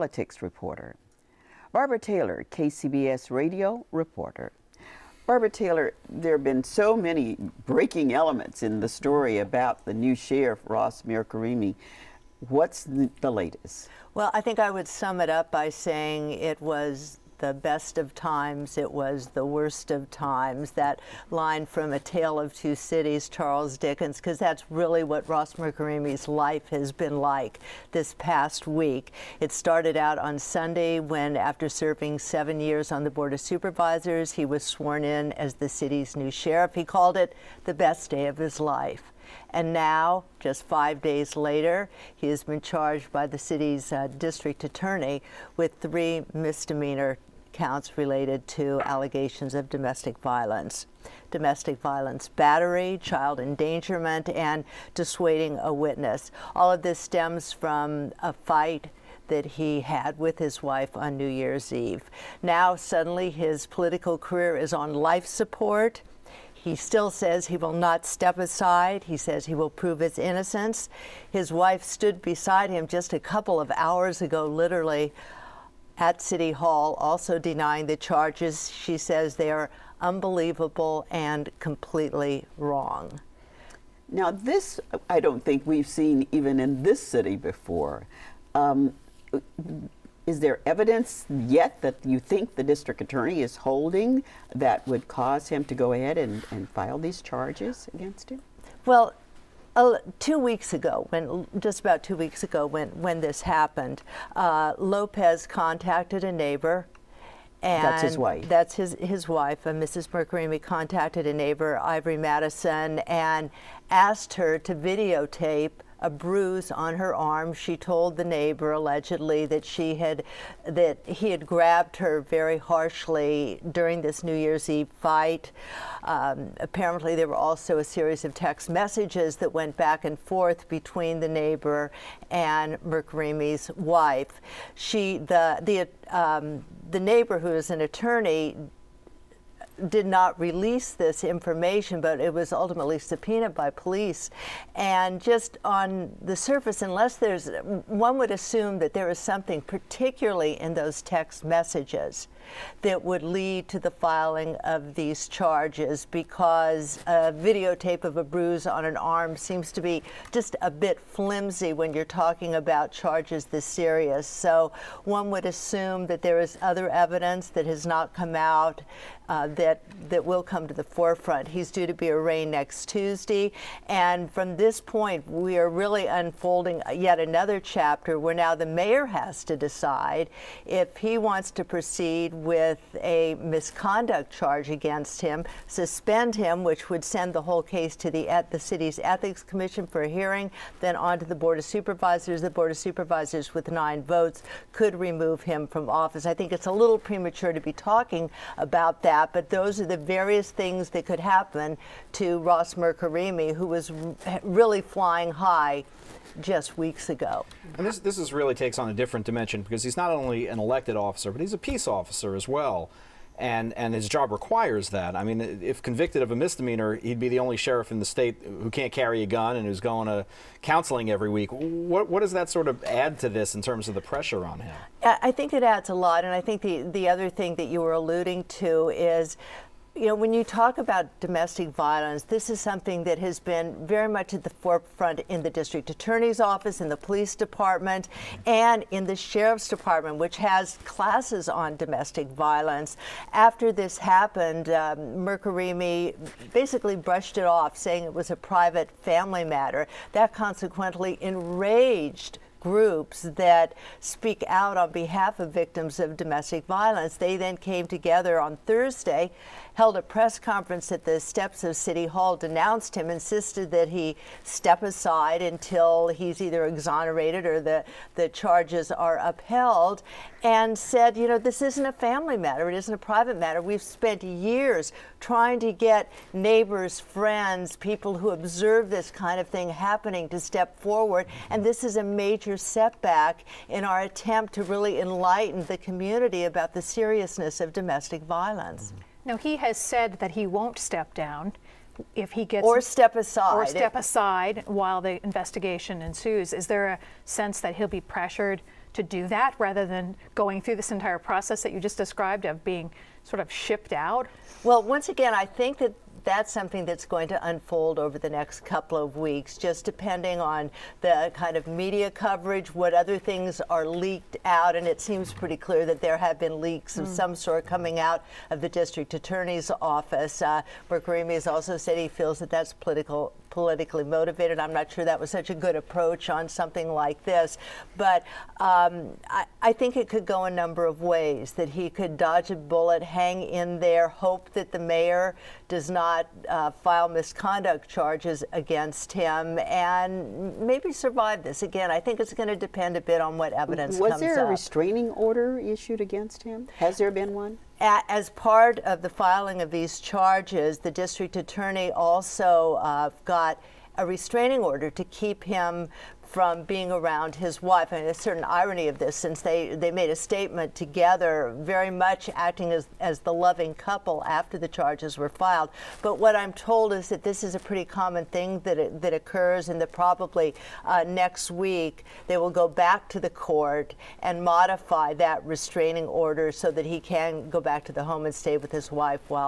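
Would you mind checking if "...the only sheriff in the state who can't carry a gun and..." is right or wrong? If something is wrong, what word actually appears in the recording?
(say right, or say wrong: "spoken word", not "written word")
right.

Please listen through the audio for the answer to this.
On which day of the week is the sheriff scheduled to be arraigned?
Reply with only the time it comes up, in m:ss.
2:52.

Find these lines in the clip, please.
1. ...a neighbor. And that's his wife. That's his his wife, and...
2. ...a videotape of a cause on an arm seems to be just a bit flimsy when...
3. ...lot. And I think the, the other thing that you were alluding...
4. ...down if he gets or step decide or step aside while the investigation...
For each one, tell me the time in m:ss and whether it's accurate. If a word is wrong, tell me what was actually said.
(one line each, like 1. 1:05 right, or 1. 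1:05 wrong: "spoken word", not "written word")
1. 1:46 right
2. 2:37 wrong: "bruise", not "cause"
3. 3:45 right
4. 4:51 wrong: "aside", not "decide".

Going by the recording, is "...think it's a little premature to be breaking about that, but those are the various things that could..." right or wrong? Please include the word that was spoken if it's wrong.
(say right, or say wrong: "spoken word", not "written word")
wrong: "talking", not "breaking".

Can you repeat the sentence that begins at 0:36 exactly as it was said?
He called it the best day of his life.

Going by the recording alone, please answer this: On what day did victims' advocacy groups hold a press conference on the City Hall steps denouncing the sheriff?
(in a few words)
Thursday.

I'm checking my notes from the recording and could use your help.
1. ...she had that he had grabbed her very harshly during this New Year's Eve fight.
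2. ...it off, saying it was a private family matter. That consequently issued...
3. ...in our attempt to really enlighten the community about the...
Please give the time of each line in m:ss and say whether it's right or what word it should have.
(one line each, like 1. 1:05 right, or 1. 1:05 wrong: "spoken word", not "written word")
1. 1:59 right
2. 4:07 wrong: "enraged", not "issued"
3. 4:43 right.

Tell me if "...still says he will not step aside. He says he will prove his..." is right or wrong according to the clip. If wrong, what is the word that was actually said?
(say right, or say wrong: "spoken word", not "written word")
right.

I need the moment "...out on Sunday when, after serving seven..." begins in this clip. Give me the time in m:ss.
0:29.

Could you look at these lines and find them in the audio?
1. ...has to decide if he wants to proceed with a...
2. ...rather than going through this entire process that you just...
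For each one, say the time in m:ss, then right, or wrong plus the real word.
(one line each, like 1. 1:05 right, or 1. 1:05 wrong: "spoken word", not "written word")
1. 2:59 right
2. 4:59 right.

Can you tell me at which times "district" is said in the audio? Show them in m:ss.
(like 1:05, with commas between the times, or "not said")
0:44, 1:32, 3:55, 5:18, 5:50.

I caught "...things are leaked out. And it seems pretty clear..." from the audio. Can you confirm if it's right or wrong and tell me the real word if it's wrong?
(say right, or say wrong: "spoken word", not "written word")
right.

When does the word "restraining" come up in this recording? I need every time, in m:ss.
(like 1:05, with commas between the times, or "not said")
5:44, 5:54, 6:15.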